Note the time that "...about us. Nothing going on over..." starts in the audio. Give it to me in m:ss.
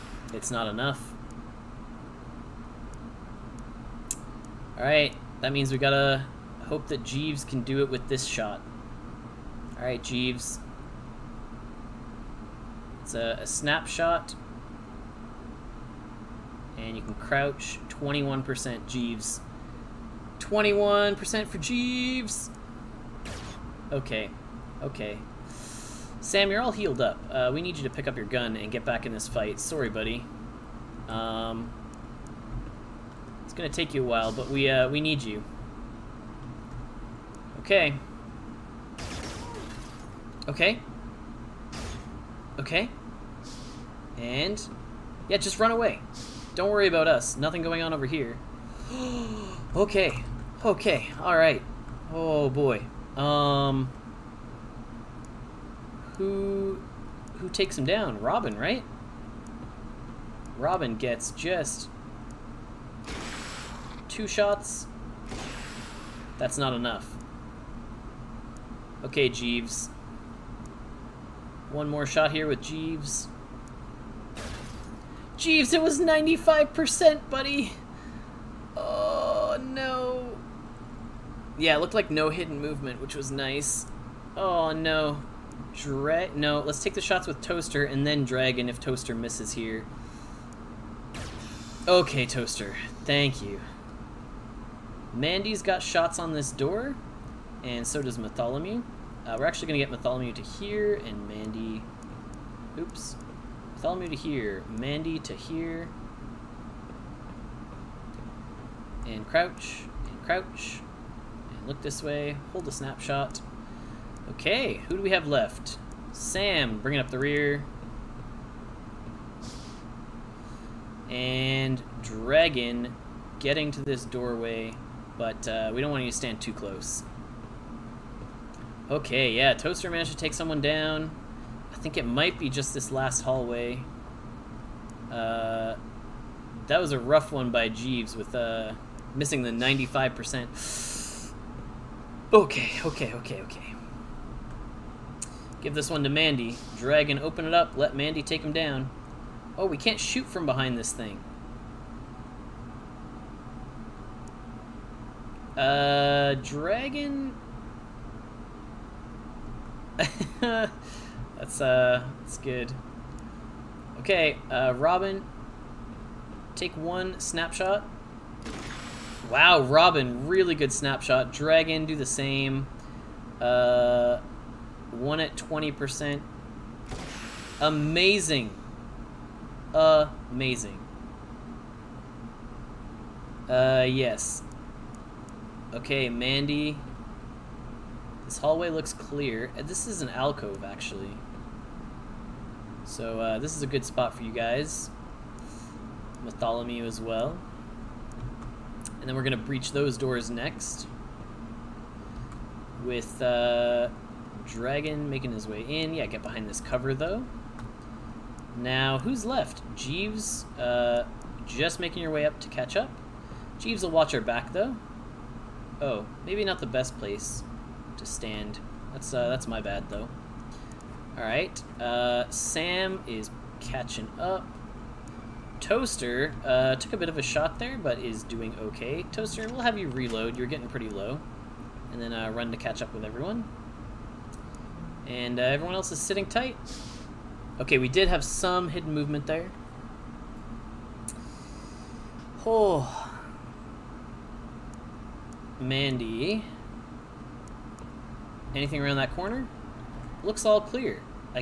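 0:46.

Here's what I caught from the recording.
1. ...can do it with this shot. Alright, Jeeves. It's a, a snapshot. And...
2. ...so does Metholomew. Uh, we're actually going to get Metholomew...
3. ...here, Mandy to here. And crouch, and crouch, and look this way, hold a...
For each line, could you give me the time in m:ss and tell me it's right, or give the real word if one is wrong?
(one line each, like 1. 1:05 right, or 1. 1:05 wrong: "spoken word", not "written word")
1. 0:07 right
2. 1:37 right
3. 1:44 right.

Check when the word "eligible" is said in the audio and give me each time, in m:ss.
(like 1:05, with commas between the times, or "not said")
not said.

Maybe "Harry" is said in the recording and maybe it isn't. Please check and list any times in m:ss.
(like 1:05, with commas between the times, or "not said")
not said.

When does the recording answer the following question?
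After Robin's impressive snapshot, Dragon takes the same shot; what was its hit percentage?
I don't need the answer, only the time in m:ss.
2:55.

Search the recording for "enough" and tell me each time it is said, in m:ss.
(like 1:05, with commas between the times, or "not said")
0:00, 1:06.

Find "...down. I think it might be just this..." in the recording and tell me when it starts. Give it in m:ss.
2:10.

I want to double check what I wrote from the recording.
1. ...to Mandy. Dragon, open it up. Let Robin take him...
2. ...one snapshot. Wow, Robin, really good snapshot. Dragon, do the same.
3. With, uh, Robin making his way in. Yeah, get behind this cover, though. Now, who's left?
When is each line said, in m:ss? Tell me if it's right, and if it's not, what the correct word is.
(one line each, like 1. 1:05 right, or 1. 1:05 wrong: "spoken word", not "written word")
1. 2:26 wrong: "Mandy", not "Robin"
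2. 2:46 right
3. 3:22 wrong: "Dragon", not "Robin".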